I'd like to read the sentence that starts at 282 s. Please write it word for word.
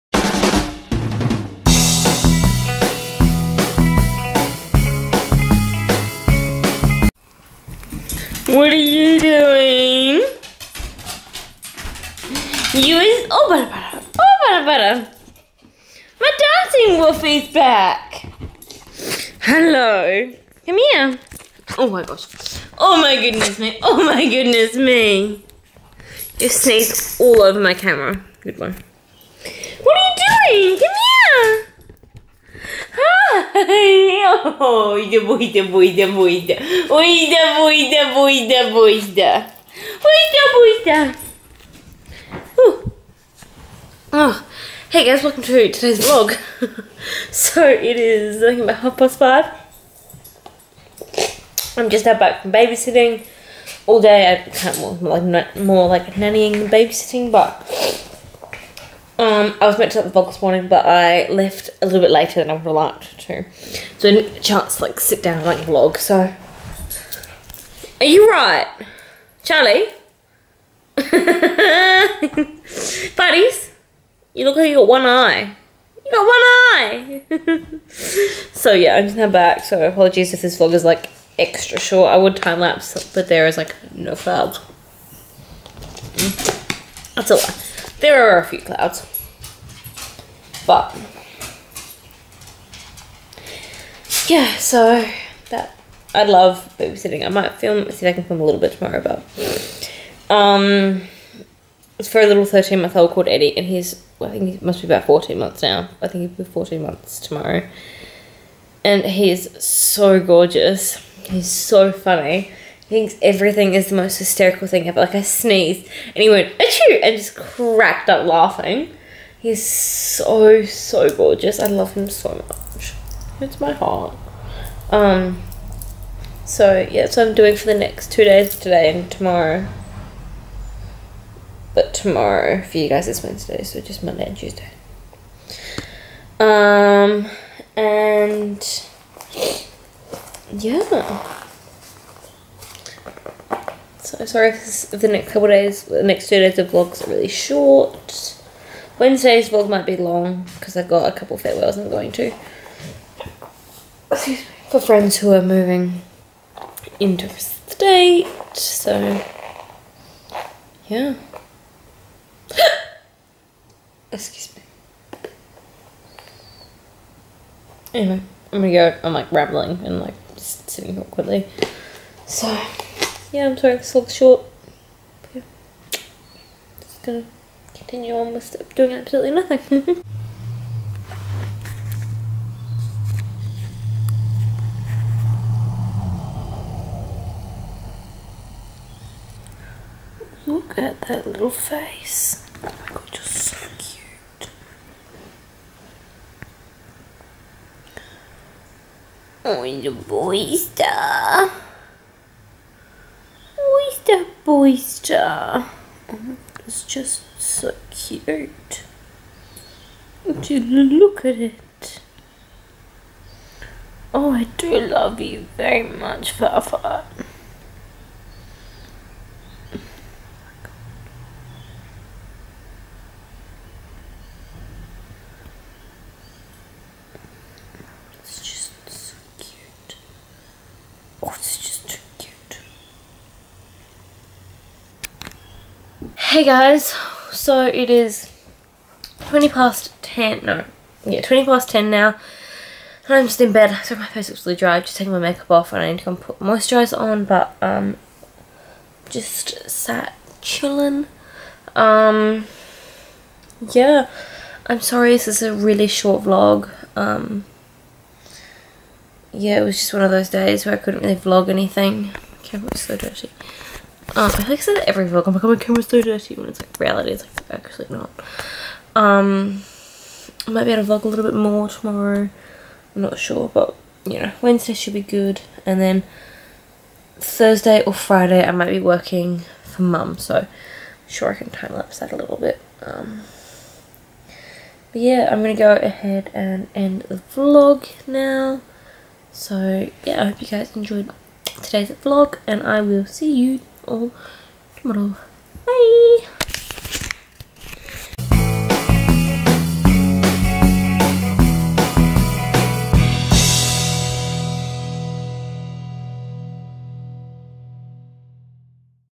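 Um, but yeah, I'm gonna go ahead and end the vlog now.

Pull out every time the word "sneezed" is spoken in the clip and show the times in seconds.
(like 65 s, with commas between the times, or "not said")
26 s, 115 s.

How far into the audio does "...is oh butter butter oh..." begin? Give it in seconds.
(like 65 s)
12 s.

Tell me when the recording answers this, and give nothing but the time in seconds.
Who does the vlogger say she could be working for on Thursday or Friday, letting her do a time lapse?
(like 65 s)
279 s.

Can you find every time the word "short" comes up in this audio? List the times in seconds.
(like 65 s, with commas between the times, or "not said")
81 s, 147 s, 174 s, 255 s.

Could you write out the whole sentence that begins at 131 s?
But tomorrow, for you guys, it's Wednesday, so just Monday and Tuesday.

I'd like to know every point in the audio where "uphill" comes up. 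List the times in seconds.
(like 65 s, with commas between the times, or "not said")
not said.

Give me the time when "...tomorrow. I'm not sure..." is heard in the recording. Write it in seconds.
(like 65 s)
271 s.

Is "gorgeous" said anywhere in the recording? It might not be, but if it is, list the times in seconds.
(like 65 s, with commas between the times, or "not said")
110 s, 121 s.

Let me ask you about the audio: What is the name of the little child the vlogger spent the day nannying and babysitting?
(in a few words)
Eddie.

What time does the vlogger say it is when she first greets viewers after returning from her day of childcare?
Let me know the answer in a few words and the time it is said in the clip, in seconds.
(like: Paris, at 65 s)
half past five, at 48 s.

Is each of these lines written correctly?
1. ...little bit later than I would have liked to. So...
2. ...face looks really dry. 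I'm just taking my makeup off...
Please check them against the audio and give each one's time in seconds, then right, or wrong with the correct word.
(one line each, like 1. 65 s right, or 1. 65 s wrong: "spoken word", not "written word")
1. 61 s right
2. 244 s right.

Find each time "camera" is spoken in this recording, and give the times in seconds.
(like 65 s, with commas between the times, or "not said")
27 s, 265 s.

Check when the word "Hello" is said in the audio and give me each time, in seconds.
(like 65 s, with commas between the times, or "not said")
19 s.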